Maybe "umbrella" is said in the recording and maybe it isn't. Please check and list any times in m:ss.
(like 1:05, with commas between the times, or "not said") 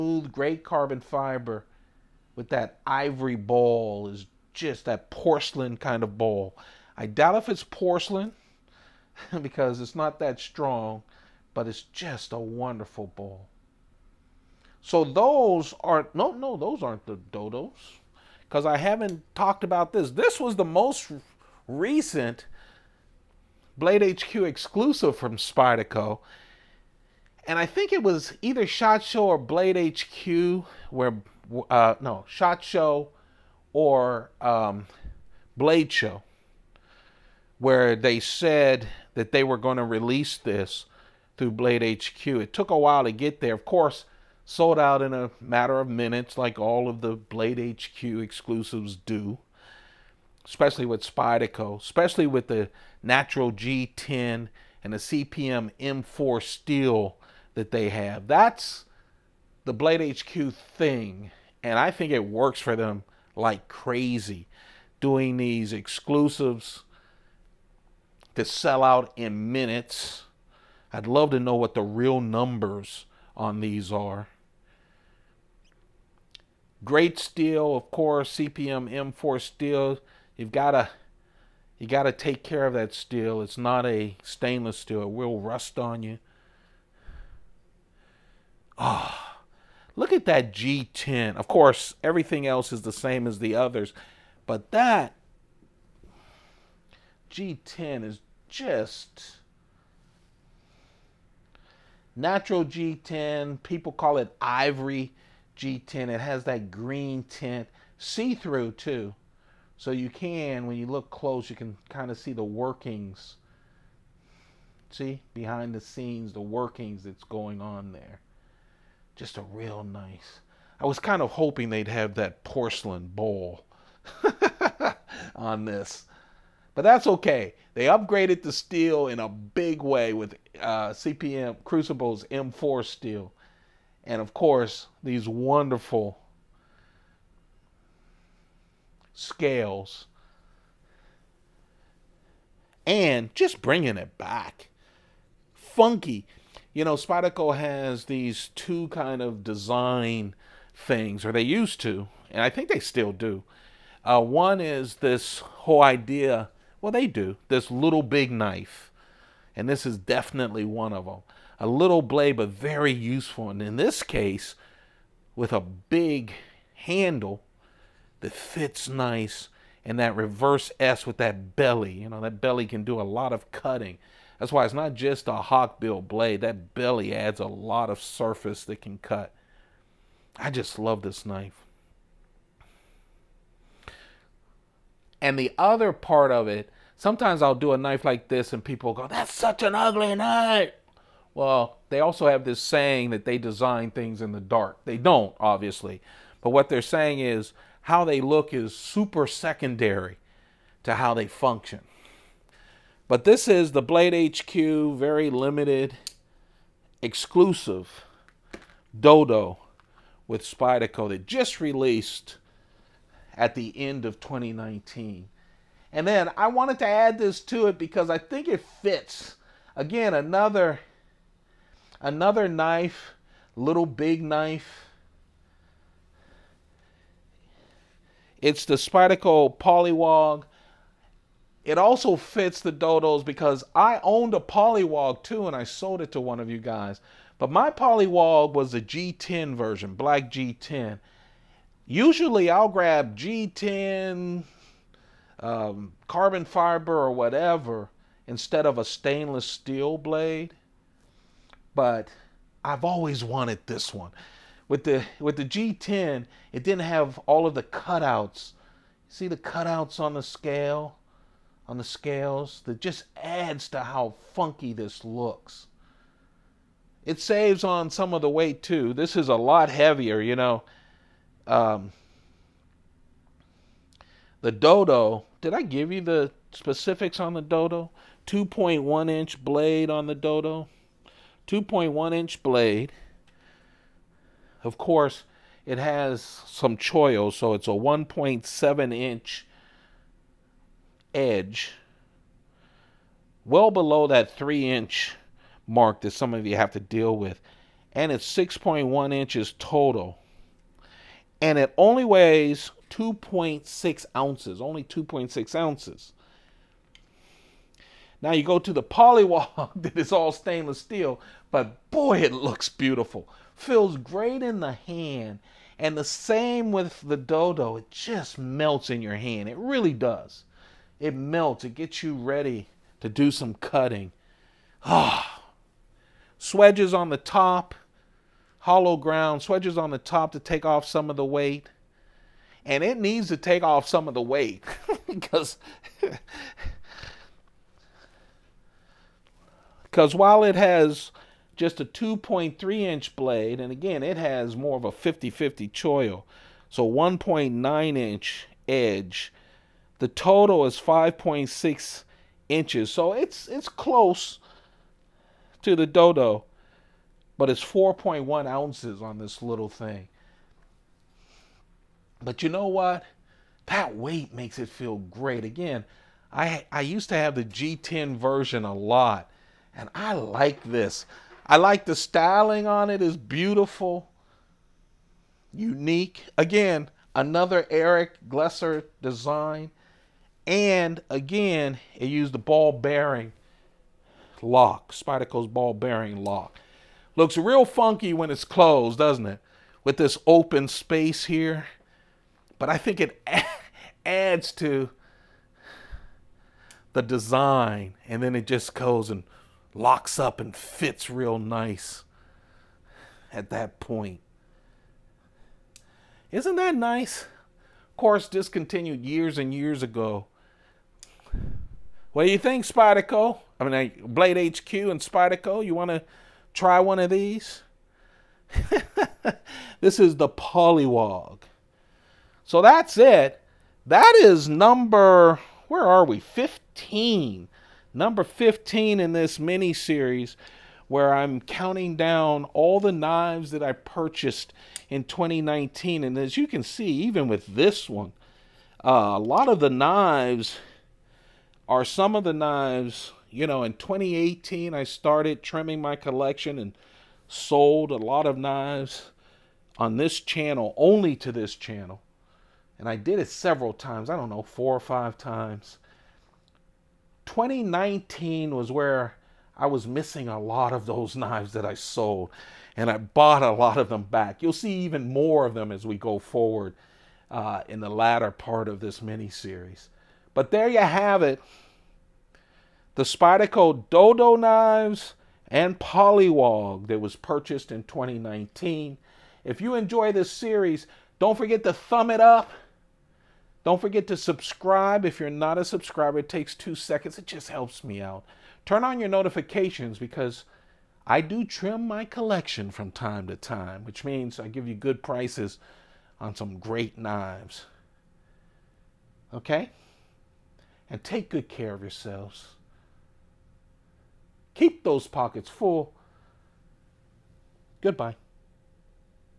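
not said.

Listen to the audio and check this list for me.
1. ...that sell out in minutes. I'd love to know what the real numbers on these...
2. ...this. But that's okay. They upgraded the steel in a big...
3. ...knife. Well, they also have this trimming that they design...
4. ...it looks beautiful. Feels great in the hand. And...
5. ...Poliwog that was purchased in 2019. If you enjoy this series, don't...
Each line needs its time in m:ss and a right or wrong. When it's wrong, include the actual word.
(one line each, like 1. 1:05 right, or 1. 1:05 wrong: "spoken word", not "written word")
1. 1:08 right
2. 2:05 right
3. 3:10 wrong: "saying", not "trimming"
4. 5:12 right
5. 7:55 right.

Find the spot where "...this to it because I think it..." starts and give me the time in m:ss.
3:37.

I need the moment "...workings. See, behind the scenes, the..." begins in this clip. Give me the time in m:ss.
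1:52.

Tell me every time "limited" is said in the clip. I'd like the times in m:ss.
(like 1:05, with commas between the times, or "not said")
3:25.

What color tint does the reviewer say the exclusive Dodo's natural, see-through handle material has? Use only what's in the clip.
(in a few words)
Green.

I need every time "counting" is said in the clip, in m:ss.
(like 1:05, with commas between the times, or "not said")
7:11.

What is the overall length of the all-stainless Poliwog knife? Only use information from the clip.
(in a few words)
5.6 inches.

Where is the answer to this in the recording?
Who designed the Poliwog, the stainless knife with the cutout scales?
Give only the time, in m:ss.
6:17.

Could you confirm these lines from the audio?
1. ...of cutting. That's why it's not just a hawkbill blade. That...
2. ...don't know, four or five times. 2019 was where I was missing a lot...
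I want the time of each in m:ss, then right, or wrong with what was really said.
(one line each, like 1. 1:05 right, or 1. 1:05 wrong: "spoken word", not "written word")
1. 2:53 right
2. 7:34 right.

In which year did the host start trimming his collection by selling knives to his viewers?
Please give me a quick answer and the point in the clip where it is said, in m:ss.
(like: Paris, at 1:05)
2018, at 7:23.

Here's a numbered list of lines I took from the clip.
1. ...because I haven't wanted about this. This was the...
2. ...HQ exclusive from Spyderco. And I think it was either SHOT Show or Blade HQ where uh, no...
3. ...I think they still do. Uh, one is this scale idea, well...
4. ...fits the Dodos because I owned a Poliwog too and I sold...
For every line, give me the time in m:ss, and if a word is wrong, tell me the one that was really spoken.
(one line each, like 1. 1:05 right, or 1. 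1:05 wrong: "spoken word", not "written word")
1. 0:18 wrong: "talked", not "wanted"
2. 0:24 right
3. 2:32 wrong: "whole", not "scale"
4. 3:52 right.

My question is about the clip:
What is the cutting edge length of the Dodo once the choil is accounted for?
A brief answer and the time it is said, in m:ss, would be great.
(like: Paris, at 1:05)
1.7 inches, at 4:47.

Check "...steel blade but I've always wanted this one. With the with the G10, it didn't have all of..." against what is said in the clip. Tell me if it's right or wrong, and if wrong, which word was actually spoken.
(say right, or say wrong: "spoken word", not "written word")
right.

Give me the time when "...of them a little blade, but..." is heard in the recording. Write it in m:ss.
2:40.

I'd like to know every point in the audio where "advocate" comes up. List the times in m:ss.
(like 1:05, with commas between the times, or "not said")
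not said.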